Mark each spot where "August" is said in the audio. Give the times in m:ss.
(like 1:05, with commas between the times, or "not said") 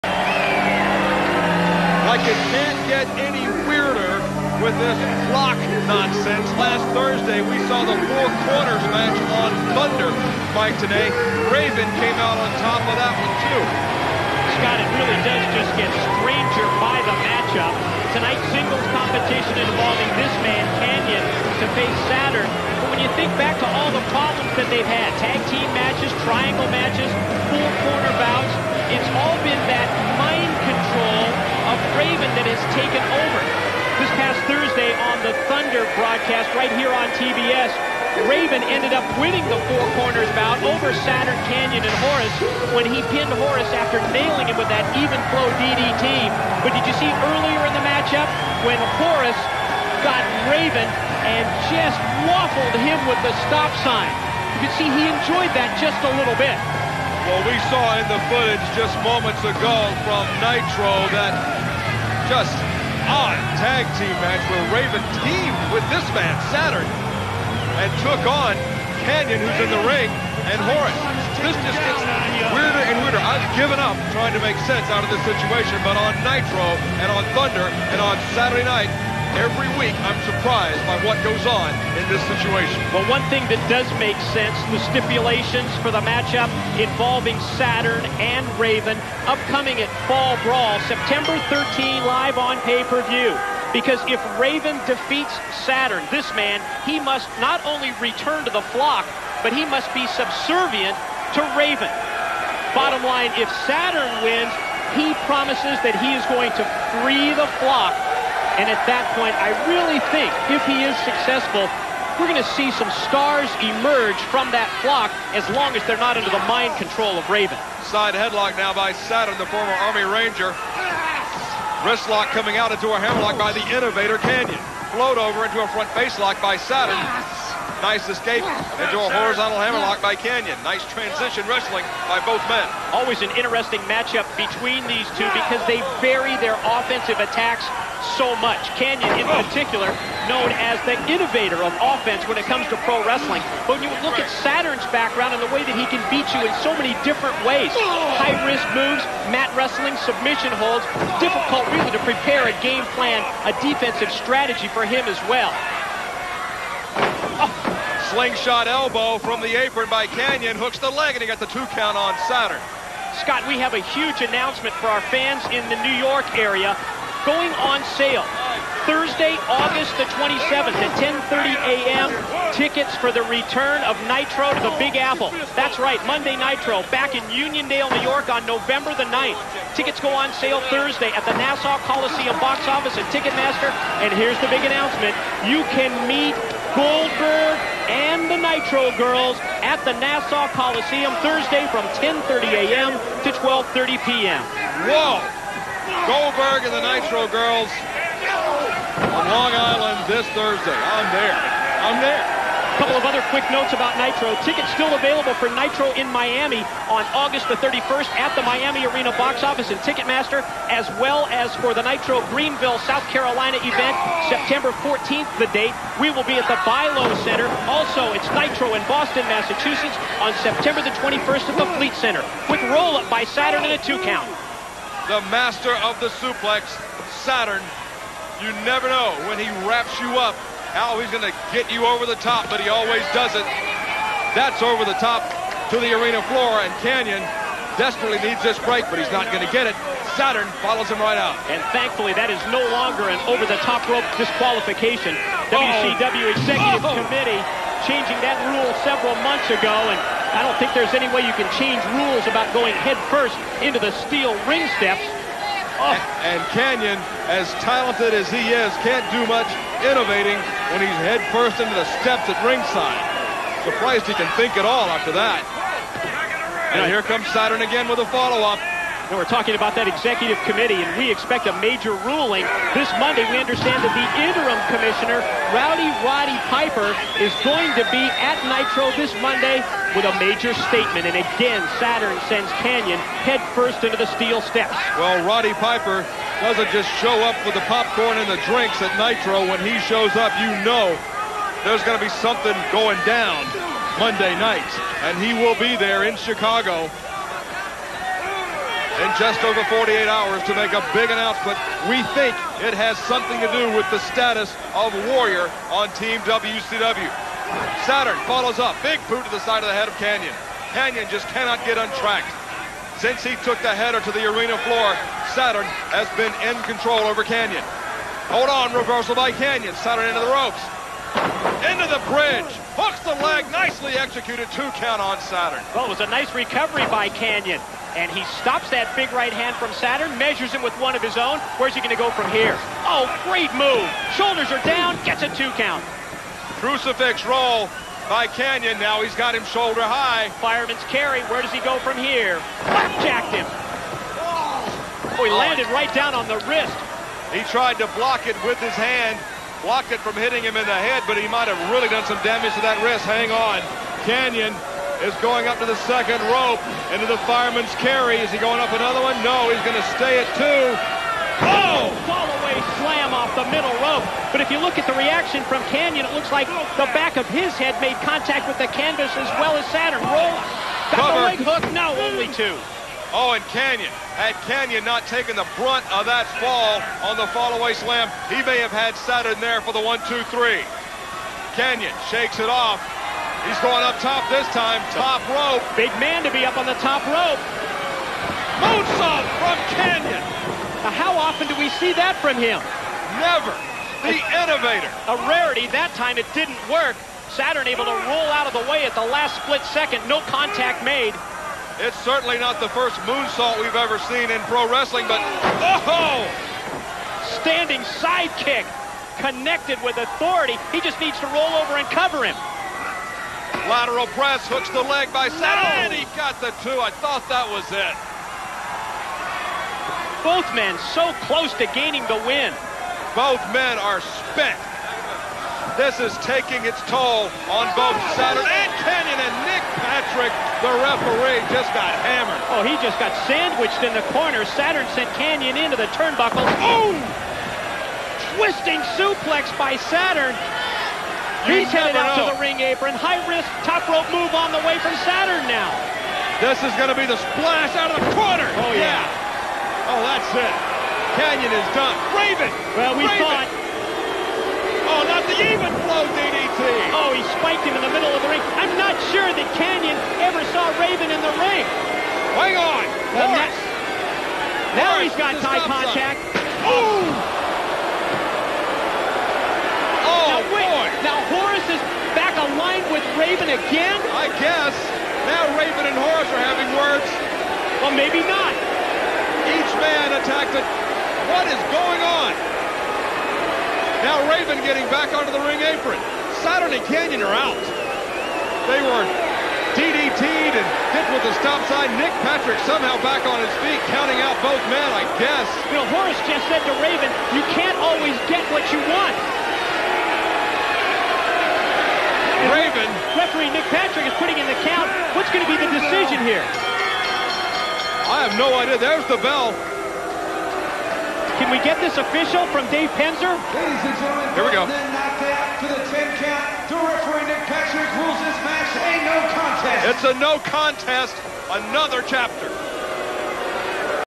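2:49, 3:27.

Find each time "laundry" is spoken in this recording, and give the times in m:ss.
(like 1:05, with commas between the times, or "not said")
not said.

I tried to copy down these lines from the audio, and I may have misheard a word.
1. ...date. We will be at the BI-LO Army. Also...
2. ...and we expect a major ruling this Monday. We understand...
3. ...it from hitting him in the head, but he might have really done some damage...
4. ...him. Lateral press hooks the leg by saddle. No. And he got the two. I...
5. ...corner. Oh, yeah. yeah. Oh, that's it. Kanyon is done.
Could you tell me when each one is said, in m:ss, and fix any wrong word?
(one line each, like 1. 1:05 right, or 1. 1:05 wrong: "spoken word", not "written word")
1. 3:35 wrong: "Center", not "Army"
2. 4:30 right
3. 5:49 right
4. 6:52 right
5. 7:28 right.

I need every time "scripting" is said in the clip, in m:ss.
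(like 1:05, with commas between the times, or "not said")
not said.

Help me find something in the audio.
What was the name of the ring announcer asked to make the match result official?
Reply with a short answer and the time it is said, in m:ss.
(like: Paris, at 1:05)
Dave Penzer, at 8:32.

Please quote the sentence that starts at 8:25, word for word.
What's going to be the decision here?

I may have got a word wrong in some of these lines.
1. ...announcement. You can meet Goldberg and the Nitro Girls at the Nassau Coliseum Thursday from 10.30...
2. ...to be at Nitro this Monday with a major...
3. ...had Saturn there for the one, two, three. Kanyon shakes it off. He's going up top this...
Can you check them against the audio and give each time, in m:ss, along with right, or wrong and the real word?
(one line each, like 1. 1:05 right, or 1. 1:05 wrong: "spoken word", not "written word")
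1. 3:04 right
2. 4:37 right
3. 6:18 right.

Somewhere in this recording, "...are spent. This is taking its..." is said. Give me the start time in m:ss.
7:03.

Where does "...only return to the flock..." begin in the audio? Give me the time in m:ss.
1:37.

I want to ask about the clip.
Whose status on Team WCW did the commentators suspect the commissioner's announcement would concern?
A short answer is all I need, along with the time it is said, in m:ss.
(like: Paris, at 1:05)
Warrior, at 5:05.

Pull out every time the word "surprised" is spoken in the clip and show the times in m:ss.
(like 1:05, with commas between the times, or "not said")
1:20, 4:23.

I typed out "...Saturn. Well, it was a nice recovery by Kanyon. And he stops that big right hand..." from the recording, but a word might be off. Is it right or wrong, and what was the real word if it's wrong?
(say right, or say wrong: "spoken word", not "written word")
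right.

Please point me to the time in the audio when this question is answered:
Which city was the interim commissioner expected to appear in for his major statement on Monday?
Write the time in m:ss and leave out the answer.
4:56.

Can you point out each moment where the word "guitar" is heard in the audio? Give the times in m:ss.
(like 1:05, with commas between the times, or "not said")
not said.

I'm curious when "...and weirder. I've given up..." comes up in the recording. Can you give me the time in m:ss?
1:12.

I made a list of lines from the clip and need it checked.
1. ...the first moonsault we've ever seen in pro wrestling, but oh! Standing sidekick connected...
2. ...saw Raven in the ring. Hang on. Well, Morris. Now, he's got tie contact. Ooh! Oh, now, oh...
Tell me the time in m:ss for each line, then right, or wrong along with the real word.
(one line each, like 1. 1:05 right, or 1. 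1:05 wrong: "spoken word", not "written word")
1. 6:42 right
2. 7:40 right.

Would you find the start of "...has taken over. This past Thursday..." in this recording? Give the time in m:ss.
0:32.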